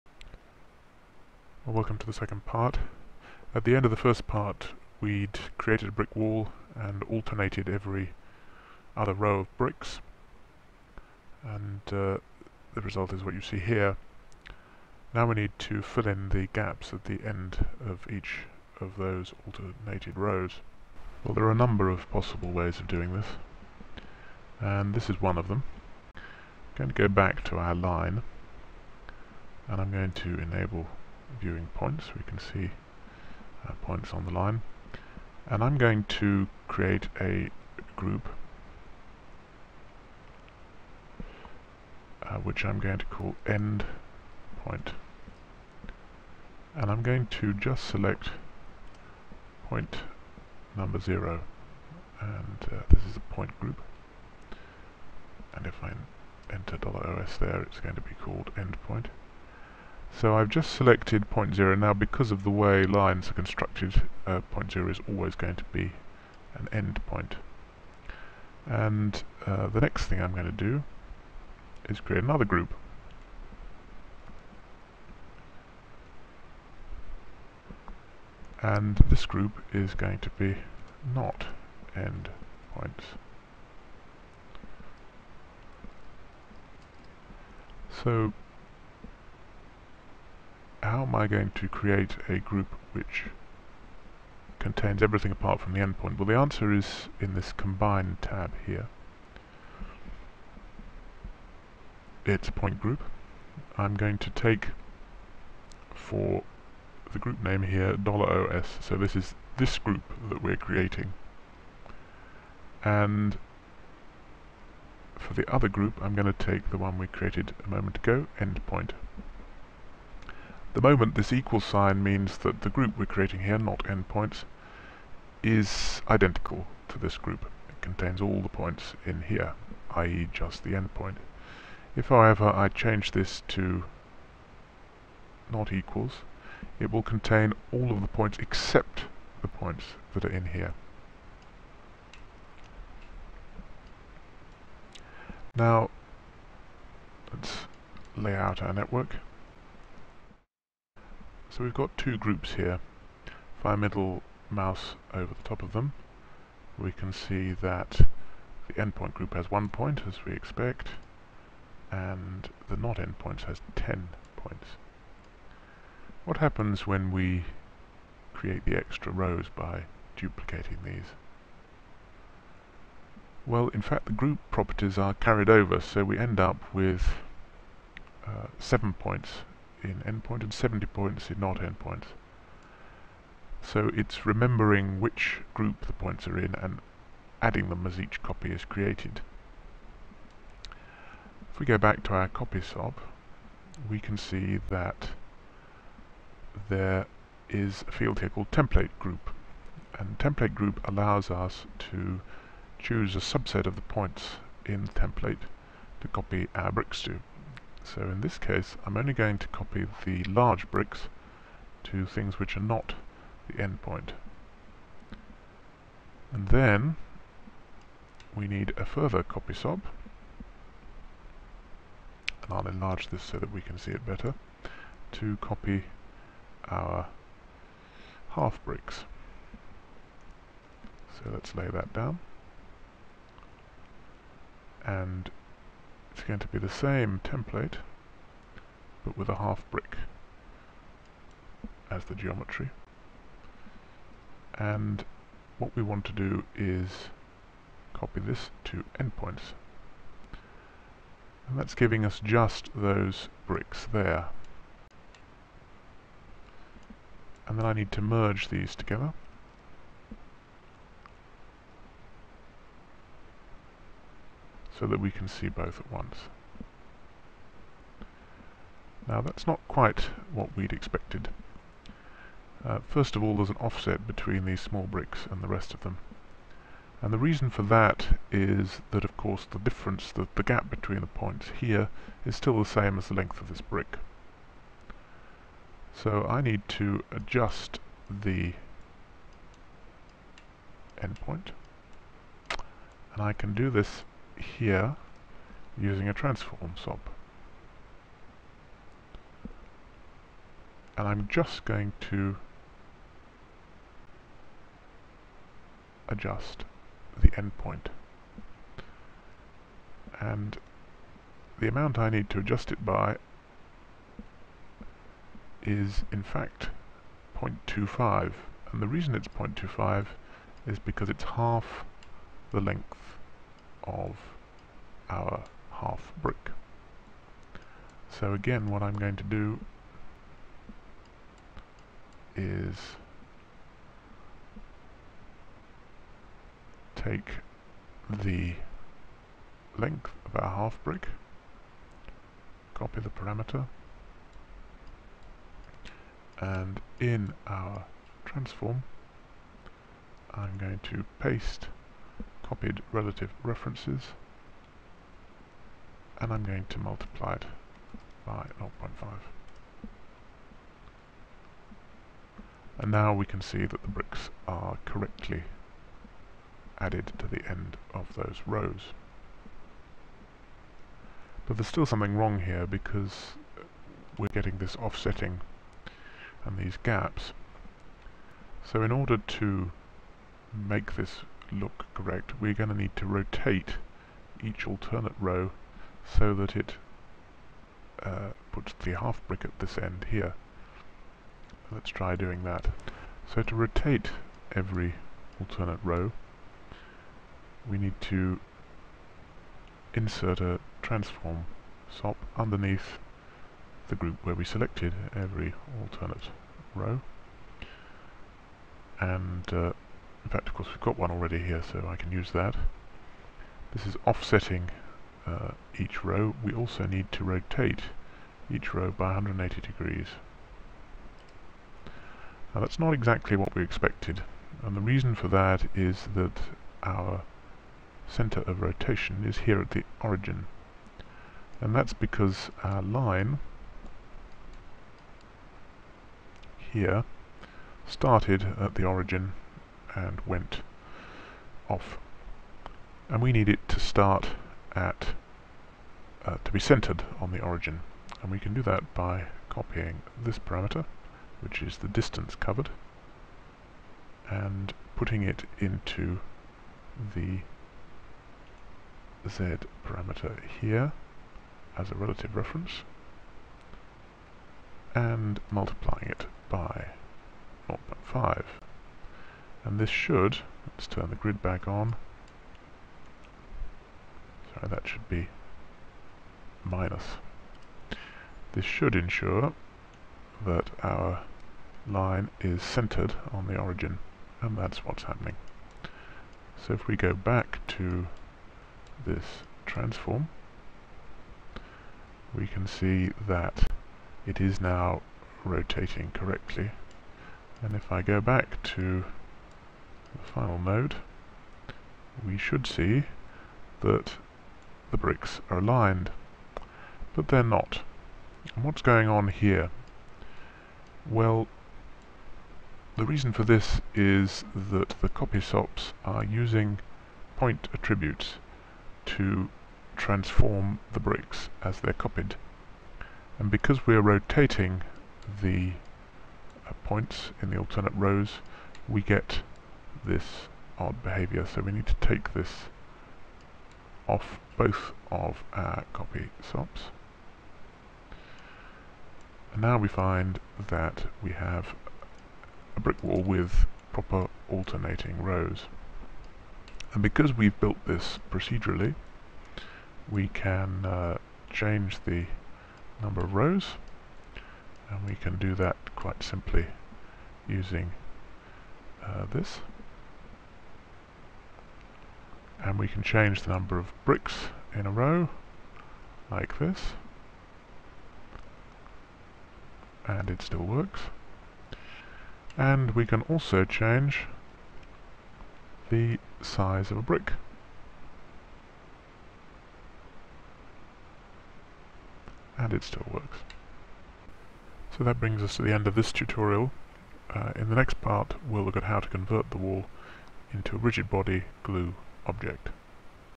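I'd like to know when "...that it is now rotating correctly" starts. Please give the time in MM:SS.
08:13.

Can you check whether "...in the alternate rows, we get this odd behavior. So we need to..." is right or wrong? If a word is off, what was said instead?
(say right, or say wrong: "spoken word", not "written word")
right.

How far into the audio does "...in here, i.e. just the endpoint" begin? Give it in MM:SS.
02:09.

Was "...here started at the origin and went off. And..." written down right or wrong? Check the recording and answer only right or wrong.
right.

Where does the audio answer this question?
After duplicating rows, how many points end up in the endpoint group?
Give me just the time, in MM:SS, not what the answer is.
02:58.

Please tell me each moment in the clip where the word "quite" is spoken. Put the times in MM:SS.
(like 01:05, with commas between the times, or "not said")
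04:29, 09:15.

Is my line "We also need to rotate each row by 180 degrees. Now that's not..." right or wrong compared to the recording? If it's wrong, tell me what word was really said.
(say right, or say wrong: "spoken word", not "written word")
right.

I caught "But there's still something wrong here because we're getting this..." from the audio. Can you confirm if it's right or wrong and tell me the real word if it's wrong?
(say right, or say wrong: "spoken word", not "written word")
right.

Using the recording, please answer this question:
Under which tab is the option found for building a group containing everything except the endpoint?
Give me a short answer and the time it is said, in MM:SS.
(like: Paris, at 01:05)
combine, at 01:37.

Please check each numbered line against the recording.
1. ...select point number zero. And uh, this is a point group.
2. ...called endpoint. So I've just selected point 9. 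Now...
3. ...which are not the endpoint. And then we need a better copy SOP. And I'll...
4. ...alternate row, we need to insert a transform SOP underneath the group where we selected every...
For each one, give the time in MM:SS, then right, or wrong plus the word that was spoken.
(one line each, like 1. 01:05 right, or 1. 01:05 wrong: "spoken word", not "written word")
1. 00:47 right
2. 00:58 wrong: "0", not "9"
3. 03:32 wrong: "further", not "better"
4. 06:35 right.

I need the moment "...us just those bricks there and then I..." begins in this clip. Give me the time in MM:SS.
04:12.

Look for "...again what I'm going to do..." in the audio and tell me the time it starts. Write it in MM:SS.
05:28.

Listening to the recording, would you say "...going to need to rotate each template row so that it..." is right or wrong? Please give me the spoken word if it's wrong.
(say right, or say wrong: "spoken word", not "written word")
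wrong: "alternate", not "template".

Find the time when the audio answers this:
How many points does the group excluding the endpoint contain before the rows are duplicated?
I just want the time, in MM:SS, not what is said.
02:43.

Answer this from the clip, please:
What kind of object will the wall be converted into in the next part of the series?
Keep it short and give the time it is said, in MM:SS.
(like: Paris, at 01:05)
rigid body glue object, at 09:50.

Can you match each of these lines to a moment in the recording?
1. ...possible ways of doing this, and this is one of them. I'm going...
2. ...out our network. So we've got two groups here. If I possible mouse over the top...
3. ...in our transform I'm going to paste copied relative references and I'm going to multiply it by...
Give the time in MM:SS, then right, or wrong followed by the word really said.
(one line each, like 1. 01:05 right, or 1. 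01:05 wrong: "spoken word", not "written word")
1. 00:22 right
2. 02:28 wrong: "middle", not "possible"
3. 05:46 right.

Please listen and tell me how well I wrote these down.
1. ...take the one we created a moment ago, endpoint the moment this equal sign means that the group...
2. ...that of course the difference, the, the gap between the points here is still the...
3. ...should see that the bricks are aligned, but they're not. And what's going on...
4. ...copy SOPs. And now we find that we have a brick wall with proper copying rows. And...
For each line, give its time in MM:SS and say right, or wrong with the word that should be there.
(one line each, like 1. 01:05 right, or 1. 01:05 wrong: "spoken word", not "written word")
1. 01:56 right
2. 04:38 right
3. 08:22 right
4. 08:55 wrong: "alternating", not "copying".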